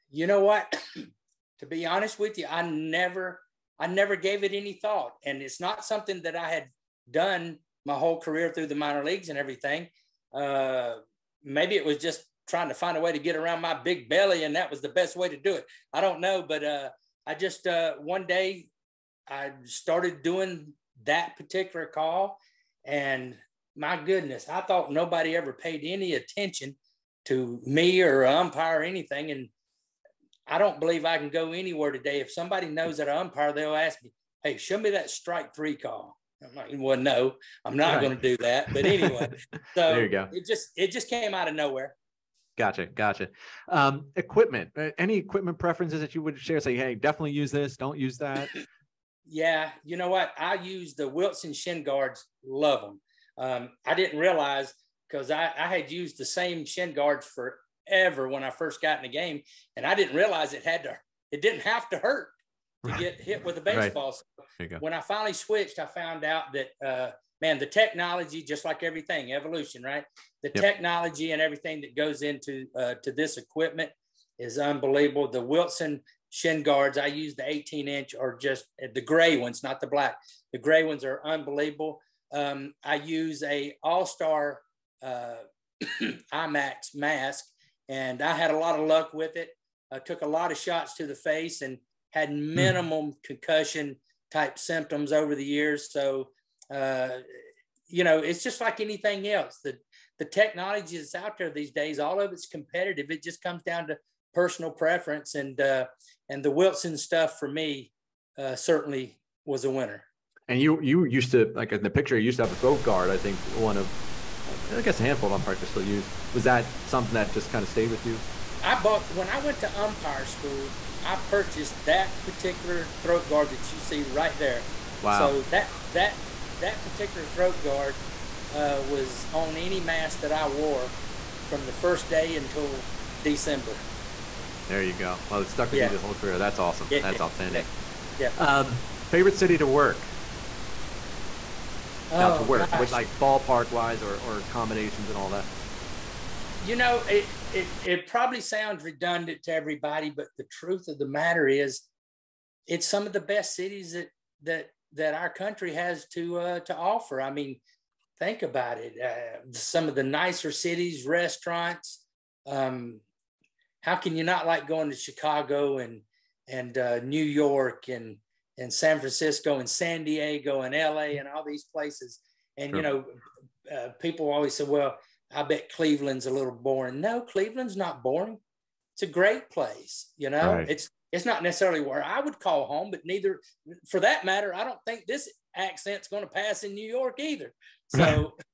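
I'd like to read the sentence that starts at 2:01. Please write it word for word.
I purchased that particular throat guard that you see right there.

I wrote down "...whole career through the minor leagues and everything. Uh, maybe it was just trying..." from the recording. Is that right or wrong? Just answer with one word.
right.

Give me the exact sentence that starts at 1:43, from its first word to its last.
It just comes down to personal preference, and uh, and the Wilson stuff for me uh, certainly was a winner.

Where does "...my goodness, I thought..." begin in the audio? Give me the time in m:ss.
0:23.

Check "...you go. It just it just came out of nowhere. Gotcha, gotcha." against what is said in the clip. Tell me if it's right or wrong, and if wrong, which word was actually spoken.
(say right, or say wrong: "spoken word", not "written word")
right.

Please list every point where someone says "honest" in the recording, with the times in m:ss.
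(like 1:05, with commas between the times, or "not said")
0:01.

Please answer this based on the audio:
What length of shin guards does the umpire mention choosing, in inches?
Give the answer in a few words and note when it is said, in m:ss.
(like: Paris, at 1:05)
18, at 1:17.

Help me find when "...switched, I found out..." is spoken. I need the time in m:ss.
1:05.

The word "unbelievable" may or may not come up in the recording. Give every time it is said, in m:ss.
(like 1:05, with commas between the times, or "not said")
1:14, 1:21.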